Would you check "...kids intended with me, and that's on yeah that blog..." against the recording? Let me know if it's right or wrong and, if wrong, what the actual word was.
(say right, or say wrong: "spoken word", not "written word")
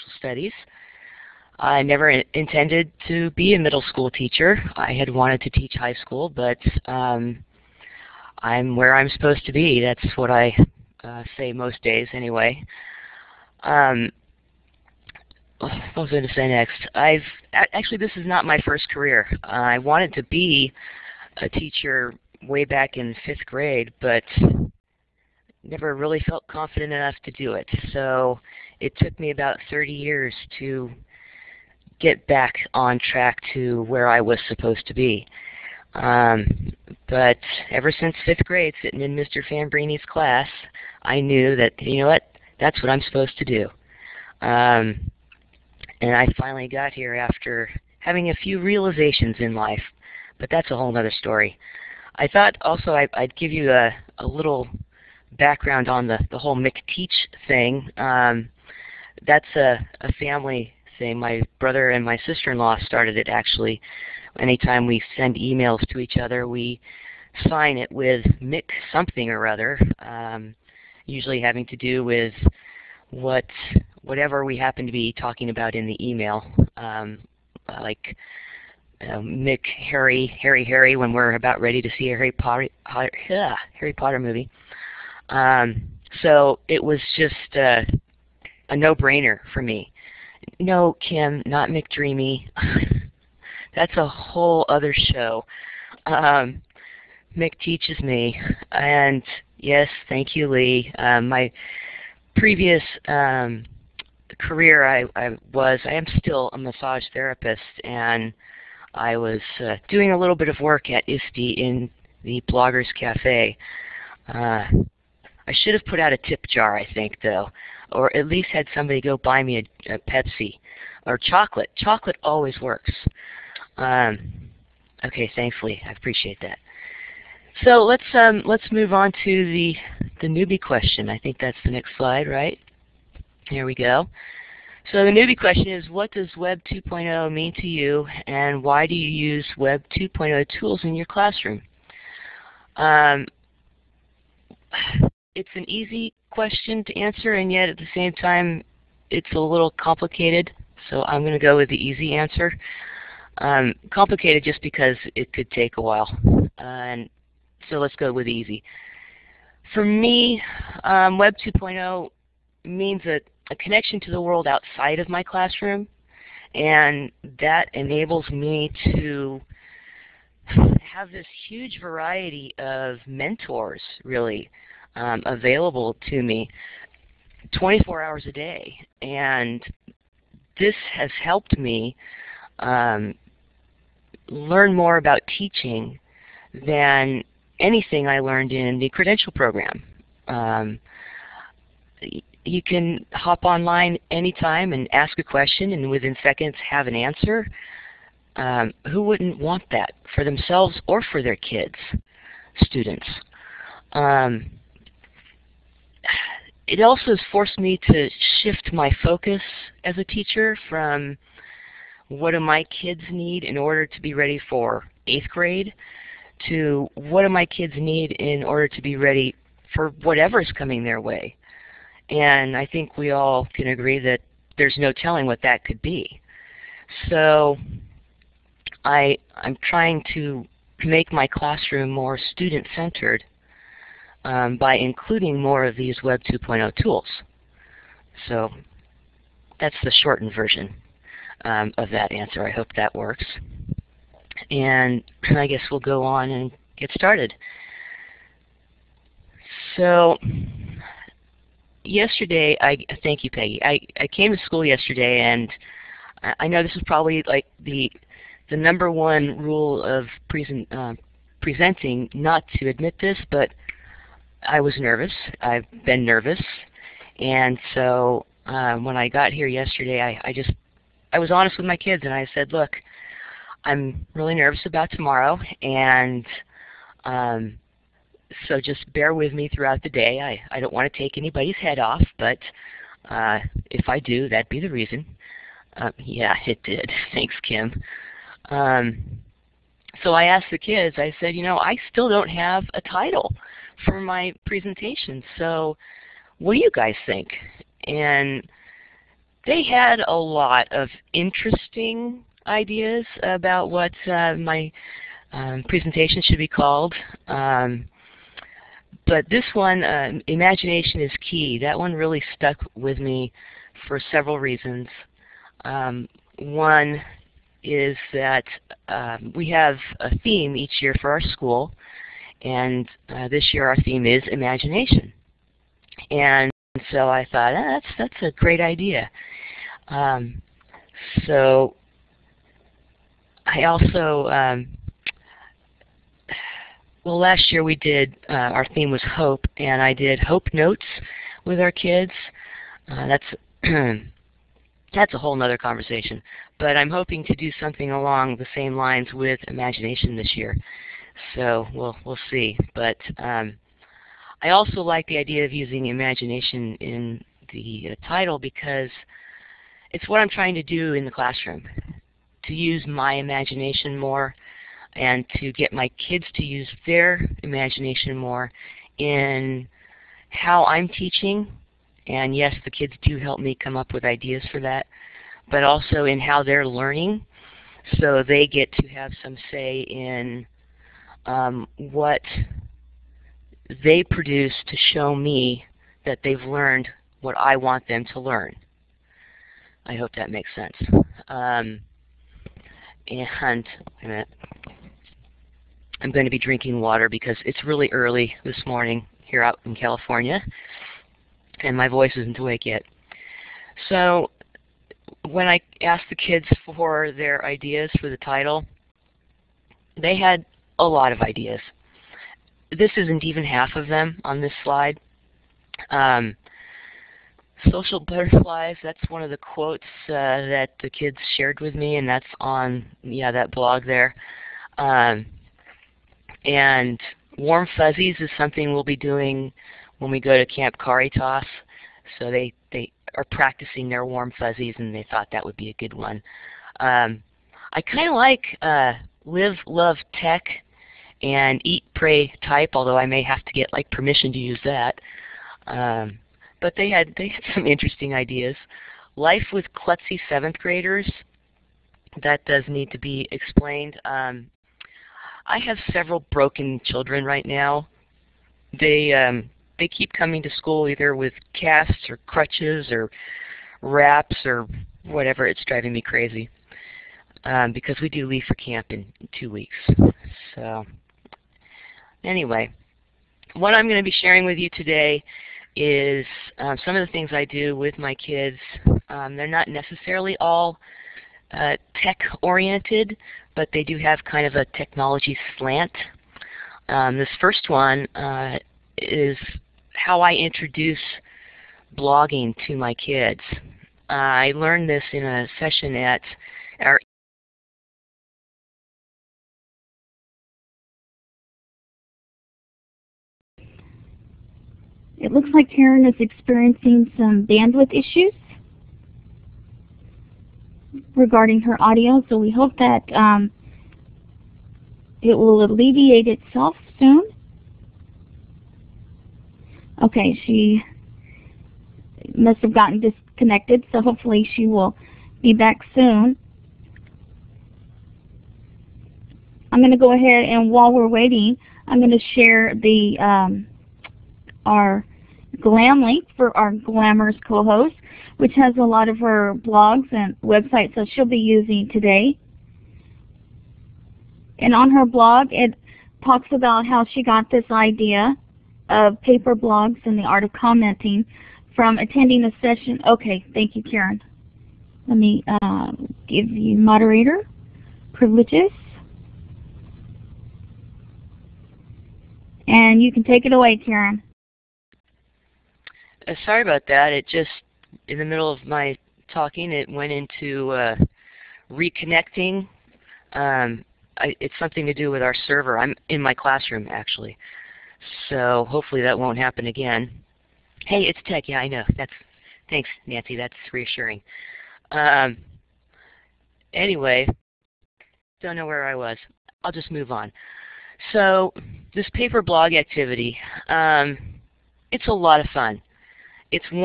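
wrong: "shared", not "intended".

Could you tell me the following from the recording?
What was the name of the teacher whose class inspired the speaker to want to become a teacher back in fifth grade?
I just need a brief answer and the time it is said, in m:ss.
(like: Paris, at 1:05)
Mr. Fambrini, at 0:39.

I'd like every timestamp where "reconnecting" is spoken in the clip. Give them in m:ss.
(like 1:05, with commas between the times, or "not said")
9:31.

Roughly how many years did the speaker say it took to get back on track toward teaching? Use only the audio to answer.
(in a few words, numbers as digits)
30.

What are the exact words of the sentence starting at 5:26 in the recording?
And so I thought, oh, that's, that's a great idea.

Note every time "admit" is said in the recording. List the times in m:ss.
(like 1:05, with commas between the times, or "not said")
4:22.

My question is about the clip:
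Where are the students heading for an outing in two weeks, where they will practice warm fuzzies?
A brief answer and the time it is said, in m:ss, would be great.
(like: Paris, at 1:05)
Camp Caritas, at 7:10.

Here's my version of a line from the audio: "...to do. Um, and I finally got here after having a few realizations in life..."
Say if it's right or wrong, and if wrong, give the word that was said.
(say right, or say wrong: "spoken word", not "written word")
right.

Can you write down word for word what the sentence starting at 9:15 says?
Let me uh, give you moderator privileges.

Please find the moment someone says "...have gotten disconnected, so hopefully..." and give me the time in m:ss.
8:42.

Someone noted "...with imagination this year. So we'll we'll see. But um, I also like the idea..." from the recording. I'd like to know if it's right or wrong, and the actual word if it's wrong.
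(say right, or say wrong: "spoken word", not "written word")
right.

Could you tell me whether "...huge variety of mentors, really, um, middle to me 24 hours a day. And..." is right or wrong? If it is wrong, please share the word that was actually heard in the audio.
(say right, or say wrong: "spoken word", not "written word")
wrong: "available", not "middle".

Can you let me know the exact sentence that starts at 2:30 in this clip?
So I'm going to go with the easy answer.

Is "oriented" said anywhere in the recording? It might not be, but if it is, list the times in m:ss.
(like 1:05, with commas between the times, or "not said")
8:02.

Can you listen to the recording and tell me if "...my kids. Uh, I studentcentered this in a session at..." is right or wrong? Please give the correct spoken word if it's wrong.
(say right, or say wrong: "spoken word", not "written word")
wrong: "learned", not "studentcentered".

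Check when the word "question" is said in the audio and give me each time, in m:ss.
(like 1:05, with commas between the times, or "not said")
2:10, 2:15, 2:26, 3:15.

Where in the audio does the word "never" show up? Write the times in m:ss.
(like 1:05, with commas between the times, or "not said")
0:01, 0:25.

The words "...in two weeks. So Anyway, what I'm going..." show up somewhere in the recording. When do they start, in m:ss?
7:48.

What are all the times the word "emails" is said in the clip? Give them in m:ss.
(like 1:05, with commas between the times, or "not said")
1:05, 1:16.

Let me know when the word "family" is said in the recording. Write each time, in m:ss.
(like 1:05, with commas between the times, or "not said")
1:00.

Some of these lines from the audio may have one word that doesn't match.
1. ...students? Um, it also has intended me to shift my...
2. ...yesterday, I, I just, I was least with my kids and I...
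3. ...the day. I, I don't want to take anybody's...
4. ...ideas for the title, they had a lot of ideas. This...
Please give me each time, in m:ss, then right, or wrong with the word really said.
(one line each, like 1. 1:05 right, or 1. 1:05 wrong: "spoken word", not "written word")
1. 3:22 wrong: "forced", not "intended"
2. 4:29 wrong: "honest", not "least"
3. 4:39 right
4. 6:47 right.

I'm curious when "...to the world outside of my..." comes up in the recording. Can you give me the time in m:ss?
2:44.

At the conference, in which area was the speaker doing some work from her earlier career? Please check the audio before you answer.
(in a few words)
Bloggers Cafe.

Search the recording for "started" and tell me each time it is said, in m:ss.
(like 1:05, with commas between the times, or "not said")
1:02, 4:06.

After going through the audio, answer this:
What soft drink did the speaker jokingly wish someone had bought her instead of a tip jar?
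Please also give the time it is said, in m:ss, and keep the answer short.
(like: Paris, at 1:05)
Pepsi, at 1:59.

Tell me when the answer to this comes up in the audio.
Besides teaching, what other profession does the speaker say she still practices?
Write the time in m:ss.
1:46.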